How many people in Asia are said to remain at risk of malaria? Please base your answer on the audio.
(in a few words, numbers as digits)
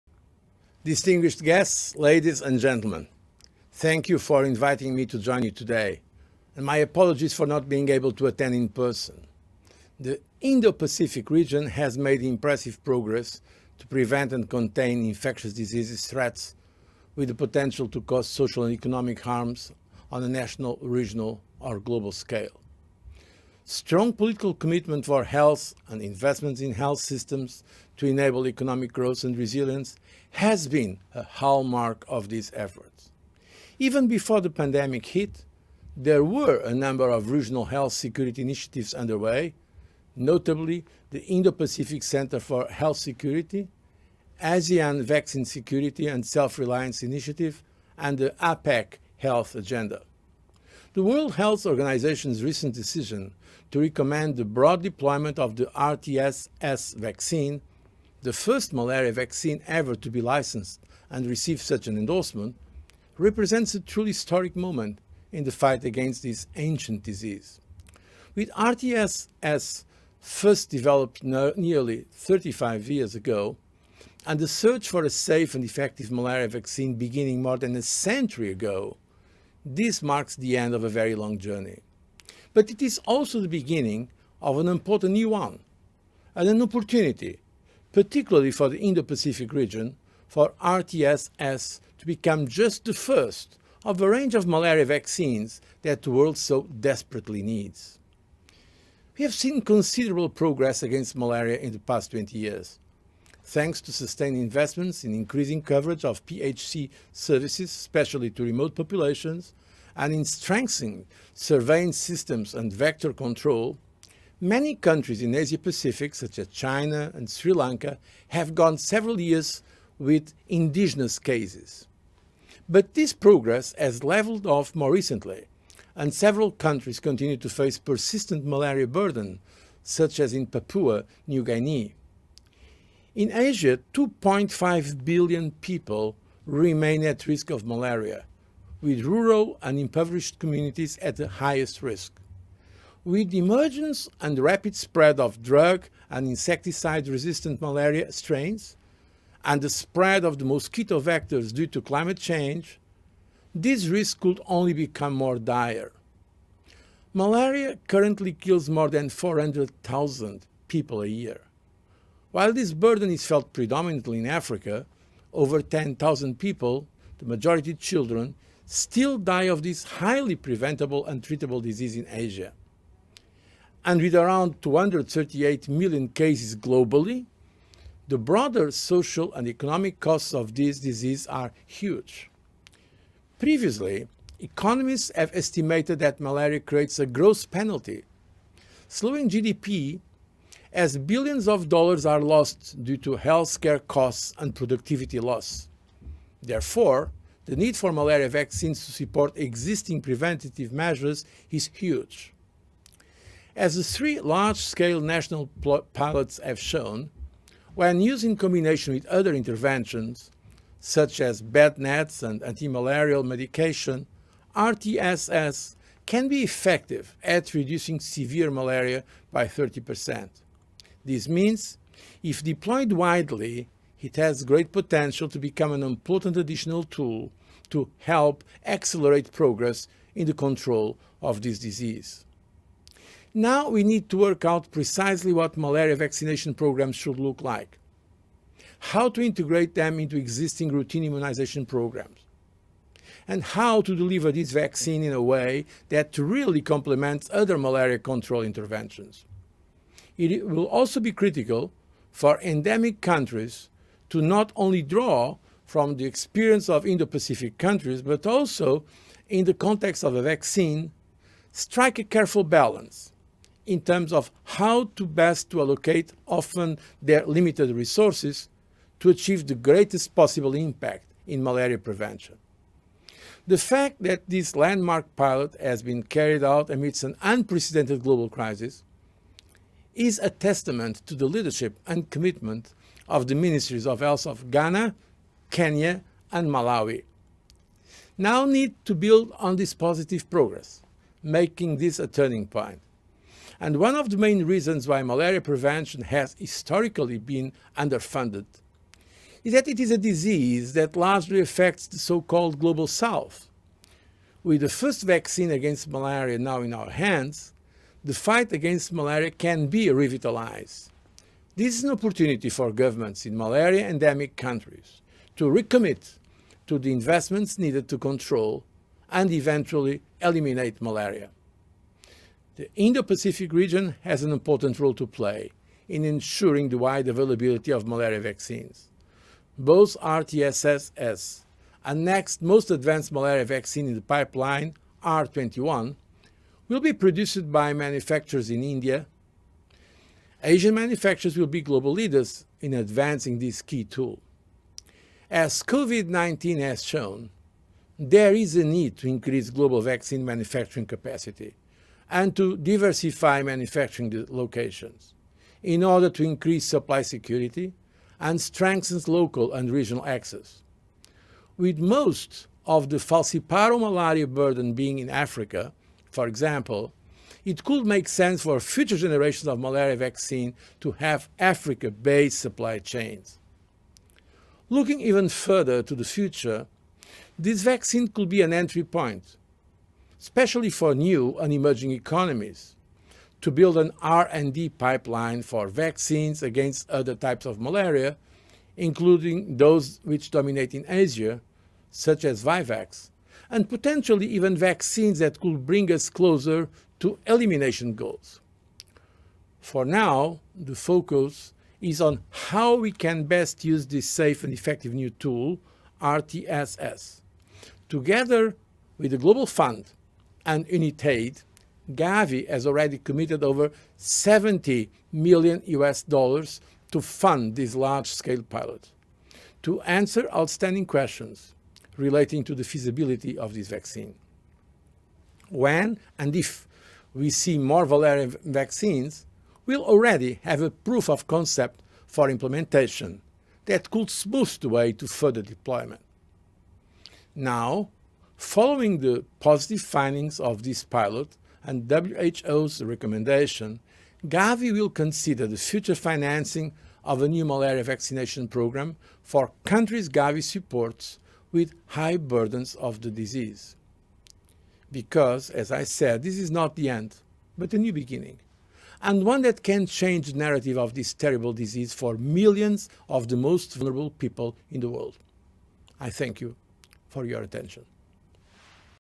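2.5 billion.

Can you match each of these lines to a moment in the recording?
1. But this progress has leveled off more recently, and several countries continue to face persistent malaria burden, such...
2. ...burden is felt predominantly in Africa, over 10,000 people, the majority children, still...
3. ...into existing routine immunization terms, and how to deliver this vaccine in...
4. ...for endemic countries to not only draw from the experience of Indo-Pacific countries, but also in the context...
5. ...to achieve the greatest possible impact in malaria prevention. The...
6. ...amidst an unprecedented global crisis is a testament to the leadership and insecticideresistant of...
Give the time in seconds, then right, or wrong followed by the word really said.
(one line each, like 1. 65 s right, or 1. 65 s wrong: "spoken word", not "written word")
1. 122 s right
2. 162 s right
3. 239 s wrong: "programs", not "terms"
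4. 252 s right
5. 268 s right
6. 276 s wrong: "commitment", not "insecticideresistant".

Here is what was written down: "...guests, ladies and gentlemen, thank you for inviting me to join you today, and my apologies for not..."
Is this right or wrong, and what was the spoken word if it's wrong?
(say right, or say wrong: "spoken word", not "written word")
right.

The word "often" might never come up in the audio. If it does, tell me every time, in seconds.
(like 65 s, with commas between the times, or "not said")
266 s.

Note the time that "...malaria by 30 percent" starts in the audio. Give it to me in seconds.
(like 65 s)
218 s.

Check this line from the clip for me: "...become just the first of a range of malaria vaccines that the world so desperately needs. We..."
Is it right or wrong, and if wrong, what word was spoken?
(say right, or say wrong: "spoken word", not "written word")
right.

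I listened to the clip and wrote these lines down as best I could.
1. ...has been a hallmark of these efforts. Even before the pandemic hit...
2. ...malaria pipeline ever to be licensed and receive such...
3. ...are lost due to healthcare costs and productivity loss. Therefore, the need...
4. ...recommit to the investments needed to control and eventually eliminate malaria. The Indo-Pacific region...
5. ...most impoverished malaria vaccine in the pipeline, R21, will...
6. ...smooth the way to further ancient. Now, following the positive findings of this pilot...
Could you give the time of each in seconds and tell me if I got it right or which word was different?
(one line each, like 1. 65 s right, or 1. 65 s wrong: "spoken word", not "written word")
1. 30 s right
2. 58 s wrong: "vaccine", not "pipeline"
3. 192 s right
4. 315 s right
5. 332 s wrong: "advanced", not "impoverished"
6. 434 s wrong: "deployment", not "ancient".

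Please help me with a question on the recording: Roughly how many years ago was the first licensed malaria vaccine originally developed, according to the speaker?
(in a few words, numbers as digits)
nearly 35 years.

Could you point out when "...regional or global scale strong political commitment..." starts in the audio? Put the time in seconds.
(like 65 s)
20 s.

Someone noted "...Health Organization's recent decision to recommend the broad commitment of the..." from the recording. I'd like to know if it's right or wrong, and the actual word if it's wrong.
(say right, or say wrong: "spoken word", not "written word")
wrong: "deployment", not "commitment".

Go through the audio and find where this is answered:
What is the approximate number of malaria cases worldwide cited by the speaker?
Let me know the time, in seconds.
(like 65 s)
174 s.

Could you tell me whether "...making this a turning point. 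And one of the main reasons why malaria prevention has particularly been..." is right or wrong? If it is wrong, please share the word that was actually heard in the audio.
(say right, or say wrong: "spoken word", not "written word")
wrong: "historically", not "particularly".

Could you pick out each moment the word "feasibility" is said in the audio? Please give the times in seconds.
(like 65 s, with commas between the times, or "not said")
422 s.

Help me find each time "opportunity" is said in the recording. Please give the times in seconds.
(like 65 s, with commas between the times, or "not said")
86 s, 311 s.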